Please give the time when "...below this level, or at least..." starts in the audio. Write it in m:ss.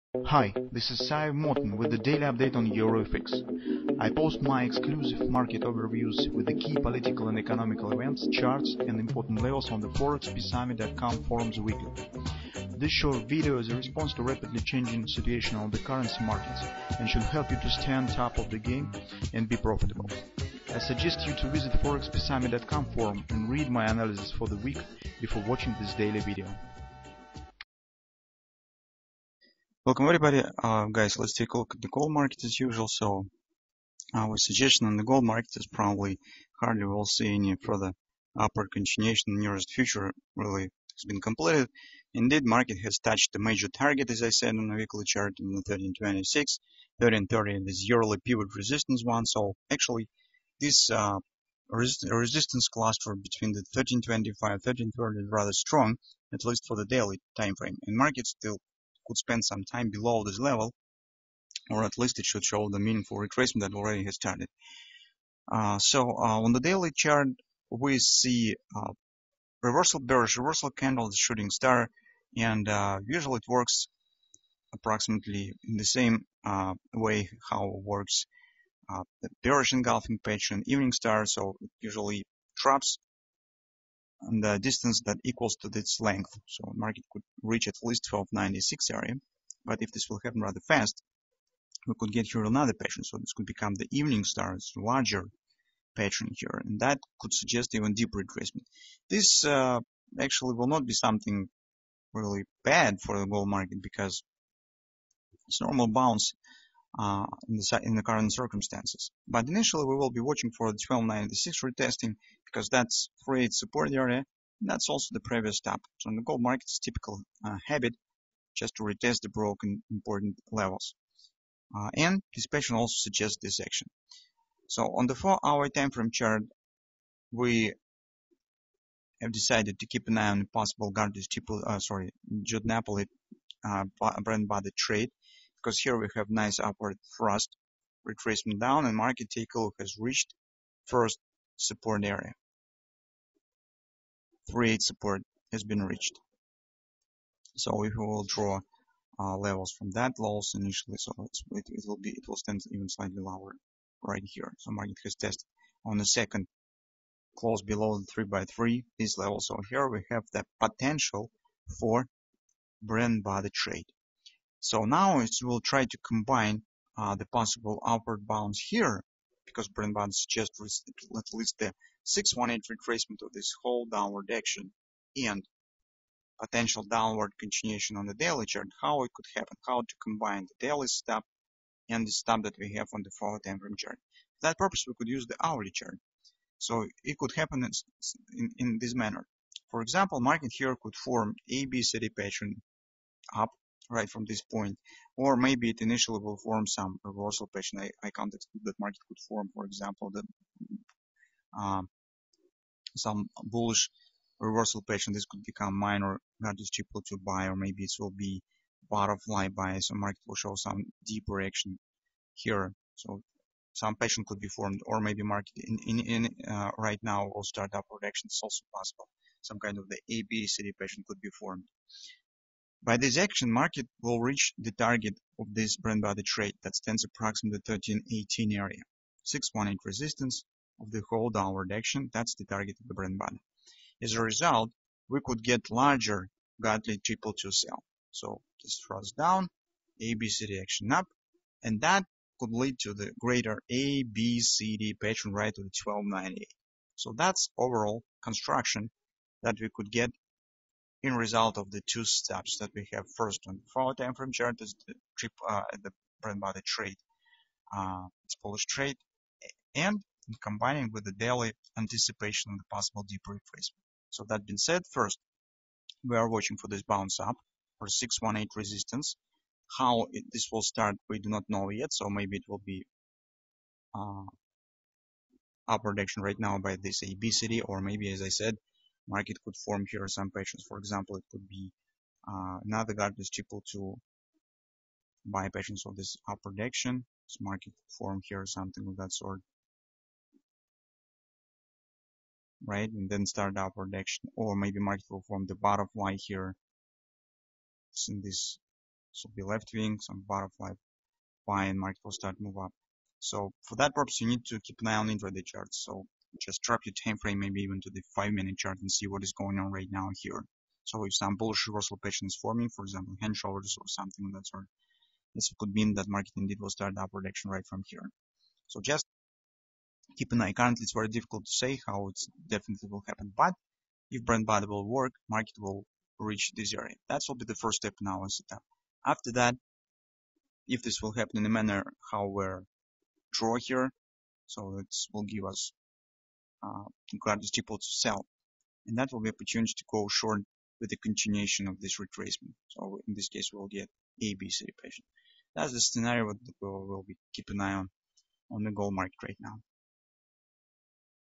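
0:59.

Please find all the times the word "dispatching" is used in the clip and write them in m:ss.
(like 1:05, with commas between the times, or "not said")
2:02.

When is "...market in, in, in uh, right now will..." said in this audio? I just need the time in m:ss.
3:35.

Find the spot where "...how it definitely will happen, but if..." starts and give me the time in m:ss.
5:21.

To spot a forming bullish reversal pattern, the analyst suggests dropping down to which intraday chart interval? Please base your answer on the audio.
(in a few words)
5 minute.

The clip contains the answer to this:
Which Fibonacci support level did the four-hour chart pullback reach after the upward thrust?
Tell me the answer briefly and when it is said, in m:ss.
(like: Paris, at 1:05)
3.8, at 2:24.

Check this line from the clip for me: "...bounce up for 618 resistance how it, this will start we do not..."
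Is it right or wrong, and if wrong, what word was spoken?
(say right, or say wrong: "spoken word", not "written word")
right.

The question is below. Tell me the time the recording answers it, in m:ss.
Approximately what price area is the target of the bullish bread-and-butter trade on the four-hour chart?
3:47.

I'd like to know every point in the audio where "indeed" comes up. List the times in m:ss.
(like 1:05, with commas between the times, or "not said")
0:42, 5:16.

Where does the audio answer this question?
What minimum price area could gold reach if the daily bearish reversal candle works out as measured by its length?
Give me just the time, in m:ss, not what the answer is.
1:28.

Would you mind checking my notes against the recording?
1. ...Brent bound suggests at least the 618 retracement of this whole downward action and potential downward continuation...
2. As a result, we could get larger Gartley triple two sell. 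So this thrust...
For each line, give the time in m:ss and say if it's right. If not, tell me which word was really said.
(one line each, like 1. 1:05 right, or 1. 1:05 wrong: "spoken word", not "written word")
1. 2:49 right
2. 3:54 right.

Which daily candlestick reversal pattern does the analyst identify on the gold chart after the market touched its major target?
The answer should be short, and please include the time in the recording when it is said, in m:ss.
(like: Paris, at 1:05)
Shooting star, at 1:11.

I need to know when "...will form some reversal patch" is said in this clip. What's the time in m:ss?
3:16.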